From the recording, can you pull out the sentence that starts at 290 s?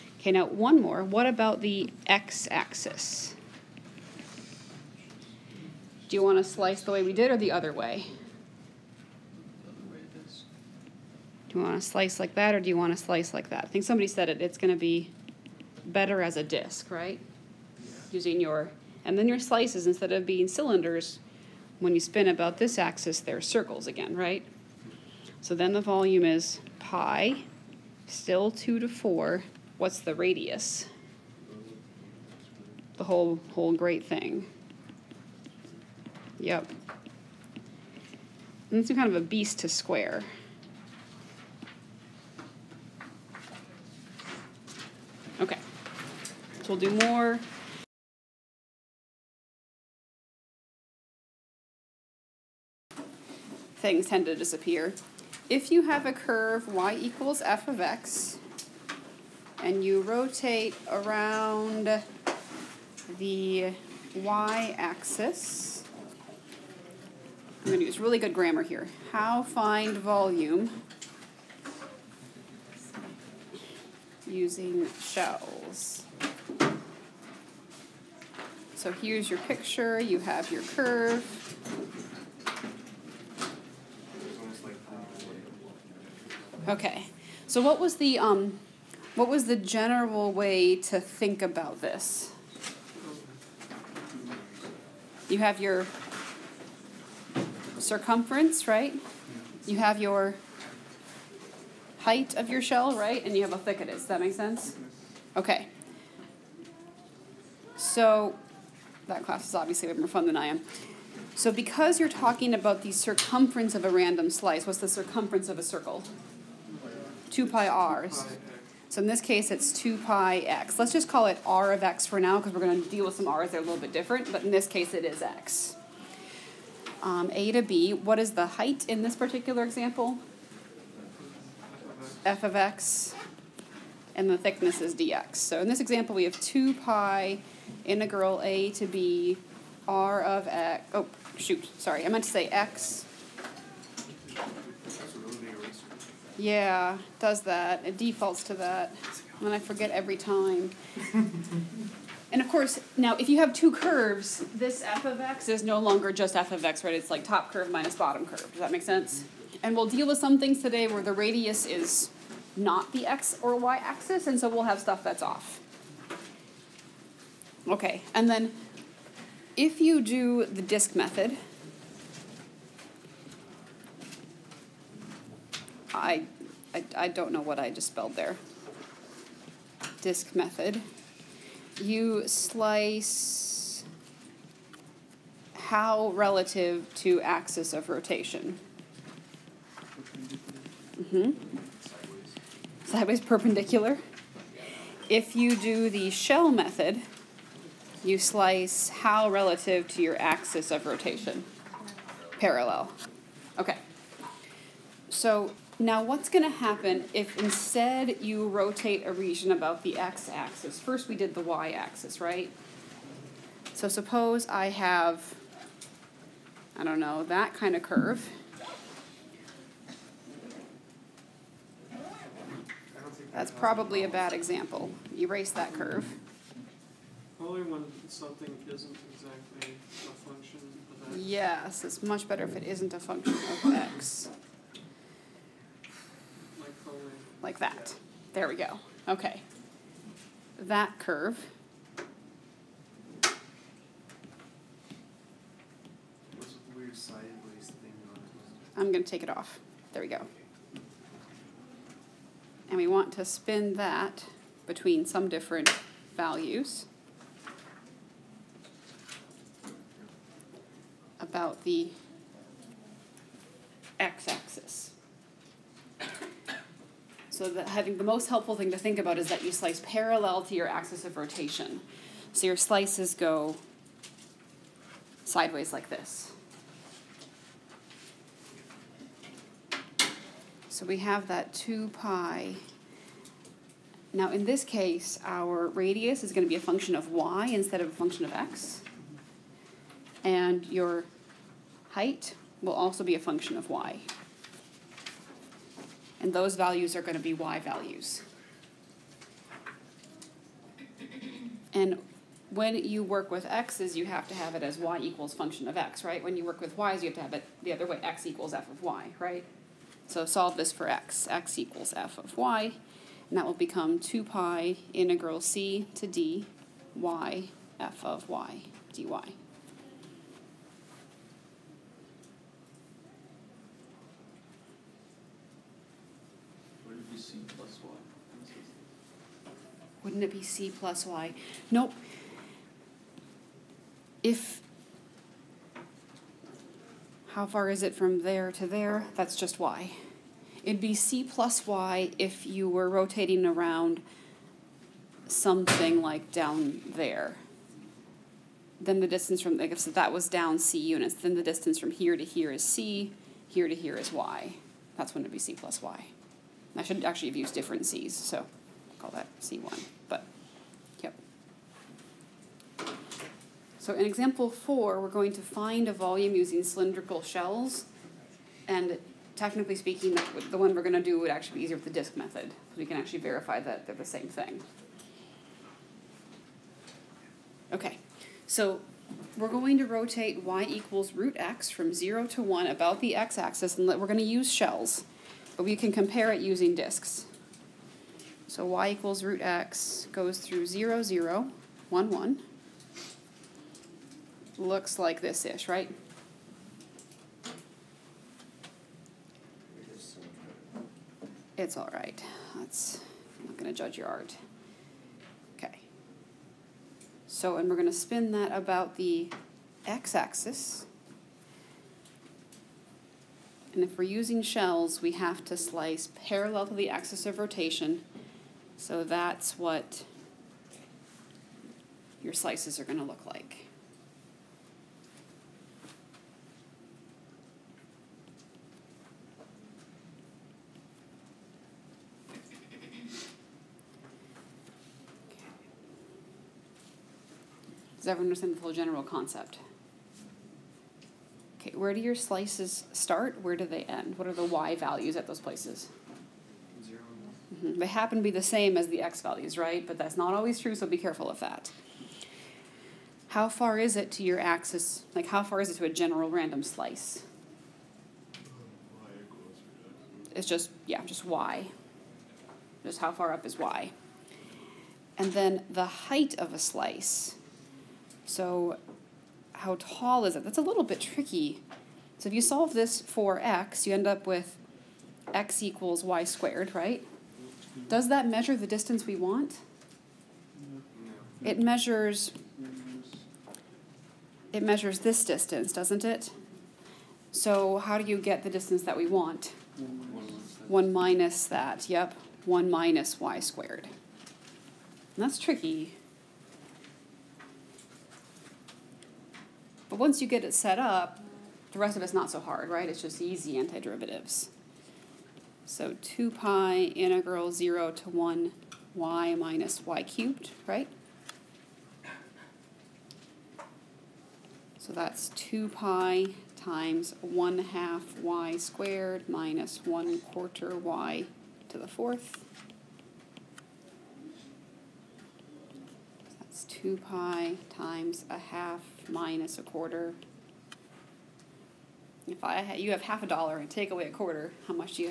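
And your height will also be a function of y and those values are going to be y values.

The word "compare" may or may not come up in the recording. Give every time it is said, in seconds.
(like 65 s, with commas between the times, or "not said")
385 s.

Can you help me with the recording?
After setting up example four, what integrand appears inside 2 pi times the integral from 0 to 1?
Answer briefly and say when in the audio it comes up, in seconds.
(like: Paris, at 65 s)
y minus y cubed, at 508 s.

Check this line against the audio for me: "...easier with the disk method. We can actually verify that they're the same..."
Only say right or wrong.
right.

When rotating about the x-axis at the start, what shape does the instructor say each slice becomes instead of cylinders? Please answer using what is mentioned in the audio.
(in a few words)
circles.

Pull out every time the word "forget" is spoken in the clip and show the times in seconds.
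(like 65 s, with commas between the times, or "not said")
149 s.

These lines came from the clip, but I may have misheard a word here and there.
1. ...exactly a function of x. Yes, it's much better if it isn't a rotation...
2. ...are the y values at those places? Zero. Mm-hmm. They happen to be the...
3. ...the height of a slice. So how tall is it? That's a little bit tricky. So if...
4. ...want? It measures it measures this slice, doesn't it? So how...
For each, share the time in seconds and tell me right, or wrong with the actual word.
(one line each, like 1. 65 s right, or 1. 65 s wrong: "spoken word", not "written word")
1. 229 s wrong: "function", not "rotation"
2. 444 s right
3. 465 s right
4. 479 s wrong: "distance", not "slice".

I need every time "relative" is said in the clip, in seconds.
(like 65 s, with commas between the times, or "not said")
186 s, 199 s.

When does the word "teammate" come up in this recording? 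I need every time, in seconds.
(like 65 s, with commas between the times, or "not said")
not said.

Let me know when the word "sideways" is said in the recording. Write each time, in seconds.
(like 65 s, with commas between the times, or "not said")
192 s, 275 s.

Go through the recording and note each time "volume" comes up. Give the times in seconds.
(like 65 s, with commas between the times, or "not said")
25 s, 69 s, 365 s.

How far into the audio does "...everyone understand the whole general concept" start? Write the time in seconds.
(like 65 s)
438 s.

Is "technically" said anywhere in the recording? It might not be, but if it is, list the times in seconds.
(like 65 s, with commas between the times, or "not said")
369 s.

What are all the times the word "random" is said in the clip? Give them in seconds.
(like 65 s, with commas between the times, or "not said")
113 s, 456 s.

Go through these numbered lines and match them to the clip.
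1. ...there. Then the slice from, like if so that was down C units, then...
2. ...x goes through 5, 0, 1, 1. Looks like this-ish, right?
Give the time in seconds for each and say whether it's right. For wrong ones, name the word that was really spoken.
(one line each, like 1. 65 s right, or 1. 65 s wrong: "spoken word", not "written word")
1. 346 s wrong: "distance", not "slice"
2. 389 s wrong: "0", not "5".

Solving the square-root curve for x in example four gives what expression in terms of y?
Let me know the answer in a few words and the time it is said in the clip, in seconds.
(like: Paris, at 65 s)
x equals y squared, at 475 s.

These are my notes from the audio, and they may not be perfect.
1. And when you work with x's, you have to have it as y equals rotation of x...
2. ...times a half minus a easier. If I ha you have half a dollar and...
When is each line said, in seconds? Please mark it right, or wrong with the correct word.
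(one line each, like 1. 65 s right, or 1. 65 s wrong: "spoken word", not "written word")
1. 301 s wrong: "function", not "rotation"
2. 527 s wrong: "quarter", not "easier".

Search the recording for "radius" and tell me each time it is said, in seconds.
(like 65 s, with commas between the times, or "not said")
30 s, 161 s, 285 s.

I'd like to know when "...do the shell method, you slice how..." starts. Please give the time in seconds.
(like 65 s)
195 s.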